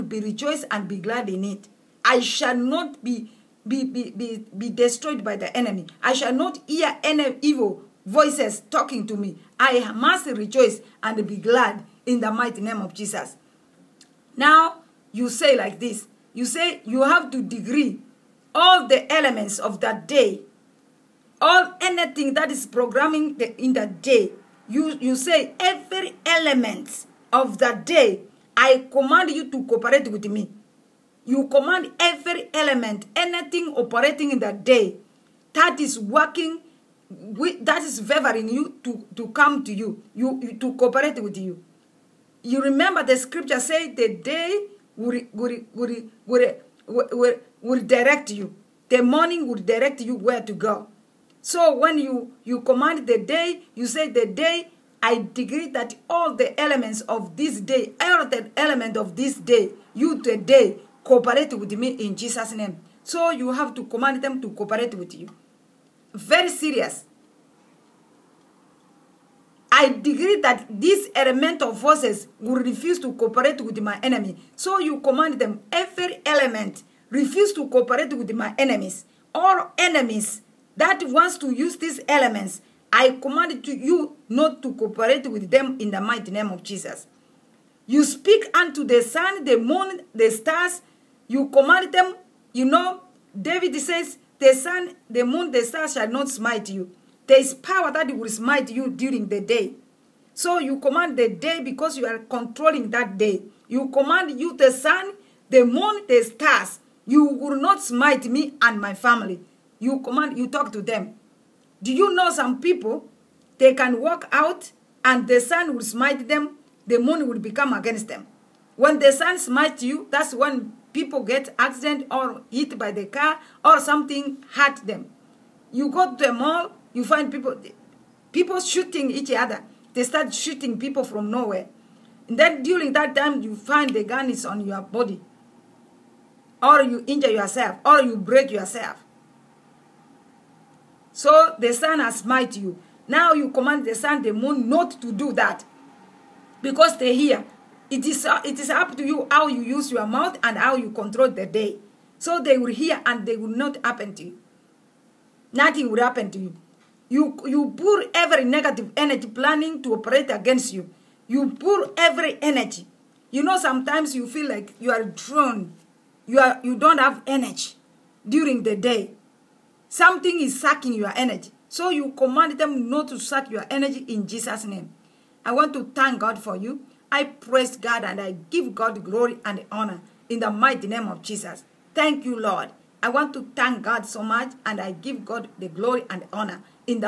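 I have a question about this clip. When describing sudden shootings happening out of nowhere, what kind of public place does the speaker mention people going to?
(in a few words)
A mall.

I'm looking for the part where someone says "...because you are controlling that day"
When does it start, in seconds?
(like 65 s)
101 s.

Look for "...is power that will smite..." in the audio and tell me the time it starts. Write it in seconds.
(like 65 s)
97 s.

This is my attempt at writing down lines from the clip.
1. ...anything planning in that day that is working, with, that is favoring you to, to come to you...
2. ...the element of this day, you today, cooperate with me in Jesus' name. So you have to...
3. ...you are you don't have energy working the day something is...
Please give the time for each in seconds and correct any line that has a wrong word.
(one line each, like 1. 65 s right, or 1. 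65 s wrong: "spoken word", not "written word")
1. 33 s wrong: "operating", not "planning"
2. 58 s right
3. 166 s wrong: "during", not "working".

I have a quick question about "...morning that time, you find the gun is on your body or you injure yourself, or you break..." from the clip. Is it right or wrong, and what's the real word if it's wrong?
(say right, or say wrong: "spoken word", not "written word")
wrong: "during", not "morning".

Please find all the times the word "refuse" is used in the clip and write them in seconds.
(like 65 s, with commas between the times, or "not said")
72 s, 77 s.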